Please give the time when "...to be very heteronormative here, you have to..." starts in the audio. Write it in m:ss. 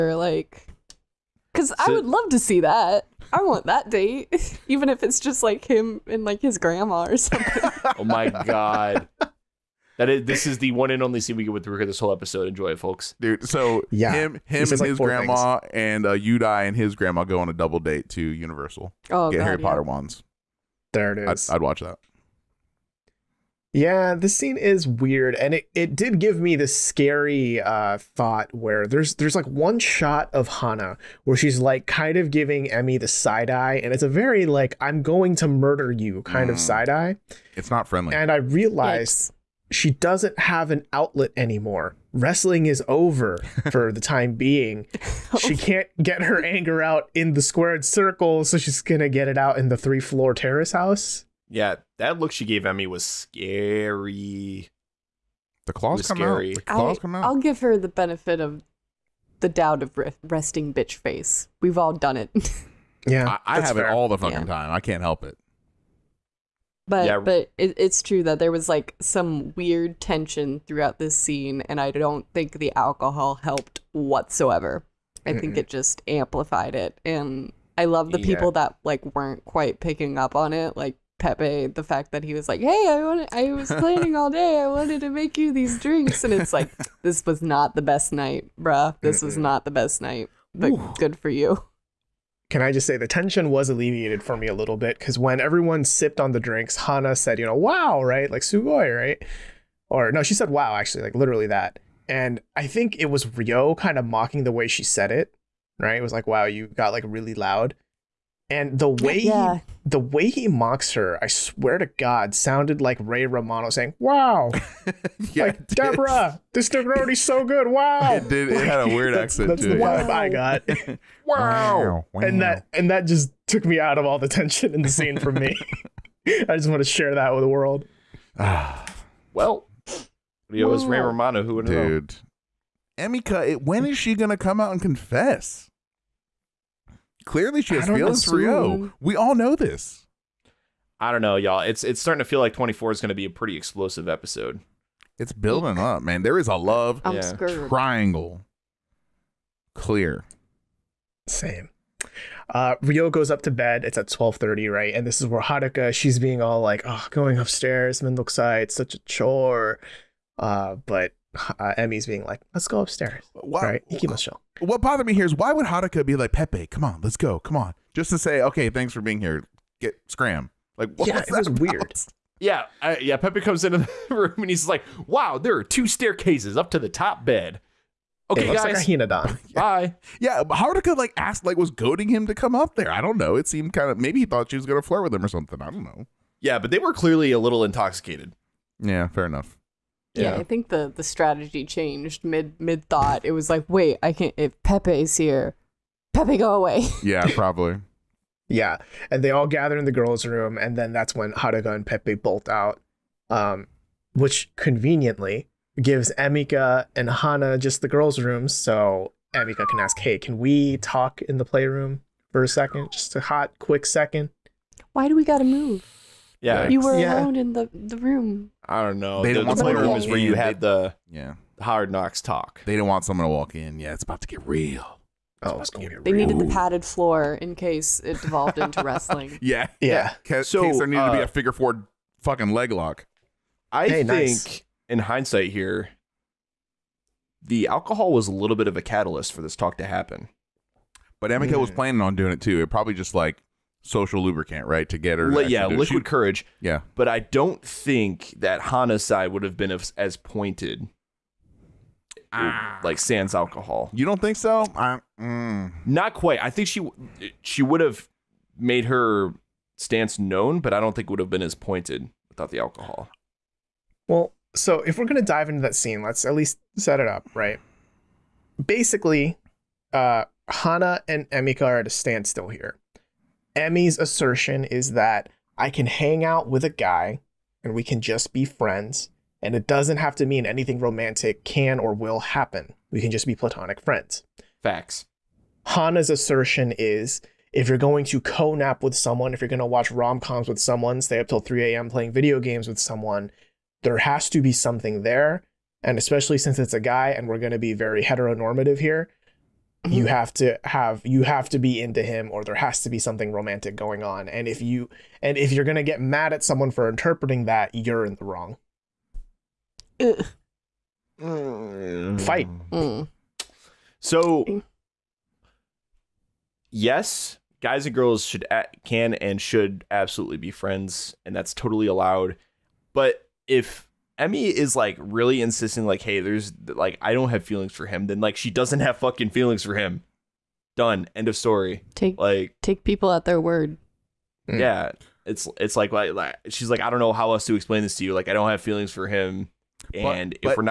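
4:57.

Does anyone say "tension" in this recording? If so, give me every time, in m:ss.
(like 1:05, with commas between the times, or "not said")
1:09, 1:33, 2:04.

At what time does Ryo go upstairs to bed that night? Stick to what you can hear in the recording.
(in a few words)
12:30.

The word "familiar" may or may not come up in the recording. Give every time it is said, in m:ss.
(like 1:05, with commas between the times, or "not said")
not said.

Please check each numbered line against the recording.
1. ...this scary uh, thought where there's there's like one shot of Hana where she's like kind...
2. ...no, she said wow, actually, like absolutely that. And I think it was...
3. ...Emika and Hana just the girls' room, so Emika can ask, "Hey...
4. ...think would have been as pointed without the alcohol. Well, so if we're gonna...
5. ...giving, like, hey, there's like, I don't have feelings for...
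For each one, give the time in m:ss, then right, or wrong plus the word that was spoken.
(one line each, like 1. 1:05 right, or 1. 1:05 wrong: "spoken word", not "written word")
1. 0:26 right
2. 1:40 wrong: "literally", not "absolutely"
3. 3:26 right
4. 4:20 right
5. 5:25 wrong: "insisting", not "giving".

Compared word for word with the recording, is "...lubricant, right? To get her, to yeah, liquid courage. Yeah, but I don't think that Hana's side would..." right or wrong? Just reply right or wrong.
right.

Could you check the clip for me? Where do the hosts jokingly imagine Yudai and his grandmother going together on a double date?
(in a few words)
Universal.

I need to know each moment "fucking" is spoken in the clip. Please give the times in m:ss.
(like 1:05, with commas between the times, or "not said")
1:04, 3:52, 5:28.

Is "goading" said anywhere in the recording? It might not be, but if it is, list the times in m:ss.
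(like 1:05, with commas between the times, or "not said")
3:01.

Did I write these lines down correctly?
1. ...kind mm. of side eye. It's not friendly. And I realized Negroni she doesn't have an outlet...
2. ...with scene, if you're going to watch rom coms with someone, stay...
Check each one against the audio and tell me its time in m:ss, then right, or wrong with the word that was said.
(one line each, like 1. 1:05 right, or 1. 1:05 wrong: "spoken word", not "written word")
1. 0:36 wrong: "Yikes", not "Negroni"
2. 4:48 wrong: "someone", not "scene".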